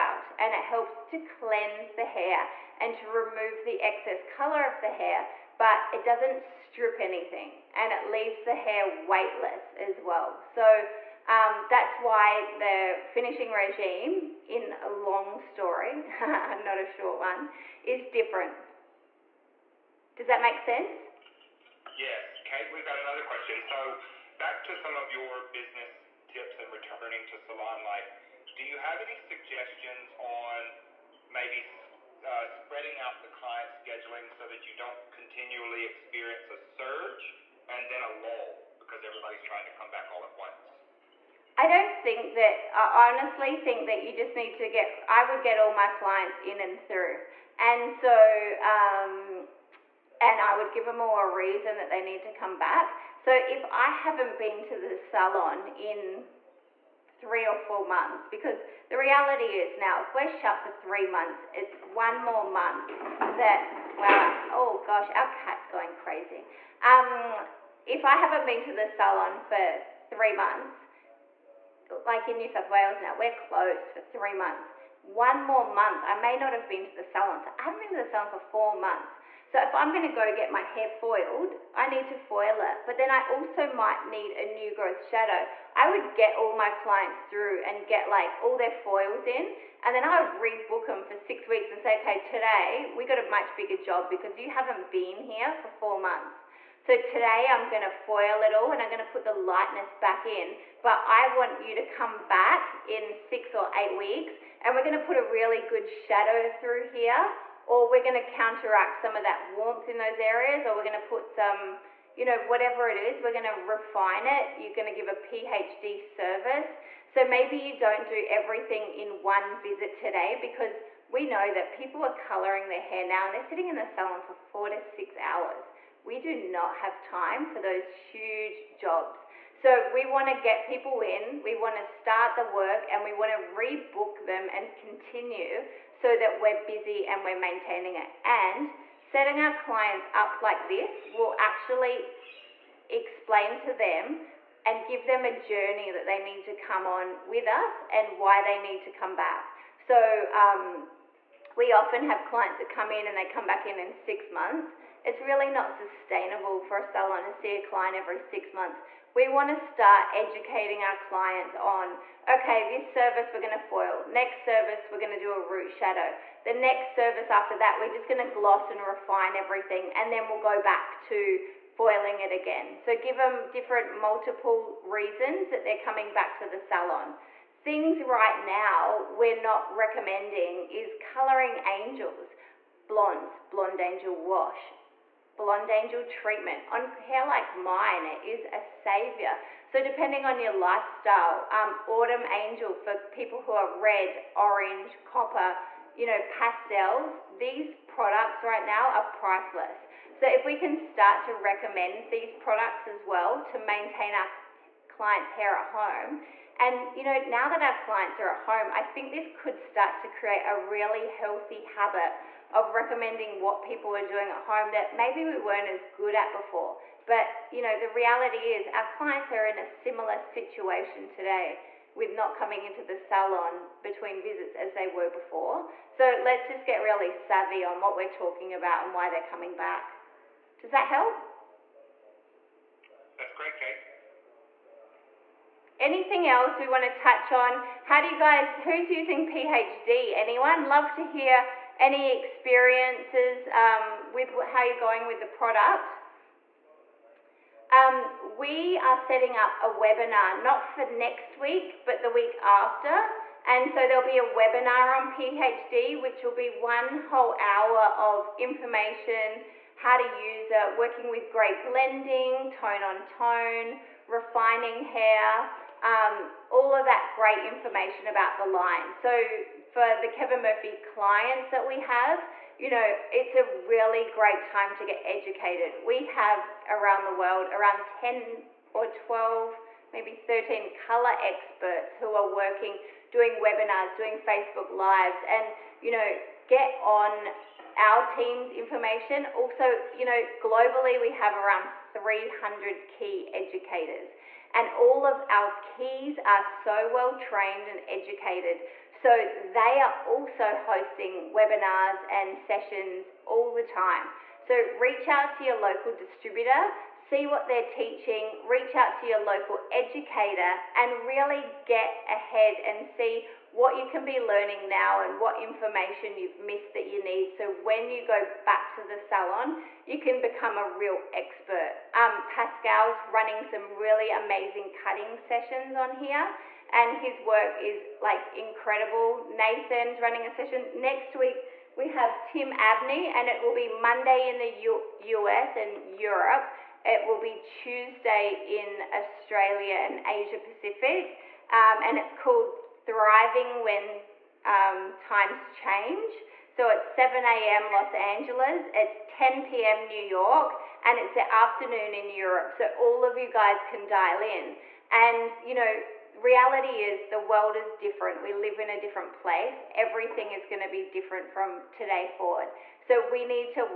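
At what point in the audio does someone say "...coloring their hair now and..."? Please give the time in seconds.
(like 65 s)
122 s.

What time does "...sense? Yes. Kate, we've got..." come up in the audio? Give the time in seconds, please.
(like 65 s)
20 s.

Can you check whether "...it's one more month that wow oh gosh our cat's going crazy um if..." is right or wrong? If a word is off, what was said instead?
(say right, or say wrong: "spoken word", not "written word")
right.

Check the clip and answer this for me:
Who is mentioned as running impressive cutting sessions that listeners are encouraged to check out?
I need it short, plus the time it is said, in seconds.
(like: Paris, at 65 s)
Pascal, at 322 s.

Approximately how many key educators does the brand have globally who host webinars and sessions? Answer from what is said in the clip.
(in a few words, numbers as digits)
300.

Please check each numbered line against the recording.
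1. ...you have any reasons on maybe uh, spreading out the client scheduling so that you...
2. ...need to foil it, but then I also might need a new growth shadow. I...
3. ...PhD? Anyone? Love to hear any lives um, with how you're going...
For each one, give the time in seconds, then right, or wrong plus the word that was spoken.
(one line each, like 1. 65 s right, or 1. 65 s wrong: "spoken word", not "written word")
1. 28 s wrong: "suggestions", not "reasons"
2. 81 s right
3. 239 s wrong: "experiences", not "lives".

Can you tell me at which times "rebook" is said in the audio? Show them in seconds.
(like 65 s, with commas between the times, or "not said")
90 s, 133 s.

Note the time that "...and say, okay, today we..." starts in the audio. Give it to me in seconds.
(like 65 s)
91 s.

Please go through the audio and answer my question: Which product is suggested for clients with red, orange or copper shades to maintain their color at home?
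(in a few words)
Autumn Angel.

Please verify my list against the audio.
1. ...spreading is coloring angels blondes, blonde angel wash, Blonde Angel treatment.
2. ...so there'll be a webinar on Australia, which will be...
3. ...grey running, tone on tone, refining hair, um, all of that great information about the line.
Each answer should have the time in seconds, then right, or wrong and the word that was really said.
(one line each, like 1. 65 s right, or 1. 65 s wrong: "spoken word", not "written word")
1. 179 s wrong: "recommending", not "spreading"
2. 253 s wrong: "PhD", not "Australia"
3. 261 s wrong: "blending", not "running".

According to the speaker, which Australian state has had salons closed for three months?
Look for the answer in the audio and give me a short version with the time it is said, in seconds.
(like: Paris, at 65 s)
New South Wales, at 72 s.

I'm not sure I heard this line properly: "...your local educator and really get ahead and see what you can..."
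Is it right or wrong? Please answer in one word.
right.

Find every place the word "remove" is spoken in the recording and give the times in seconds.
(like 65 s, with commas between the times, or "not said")
3 s.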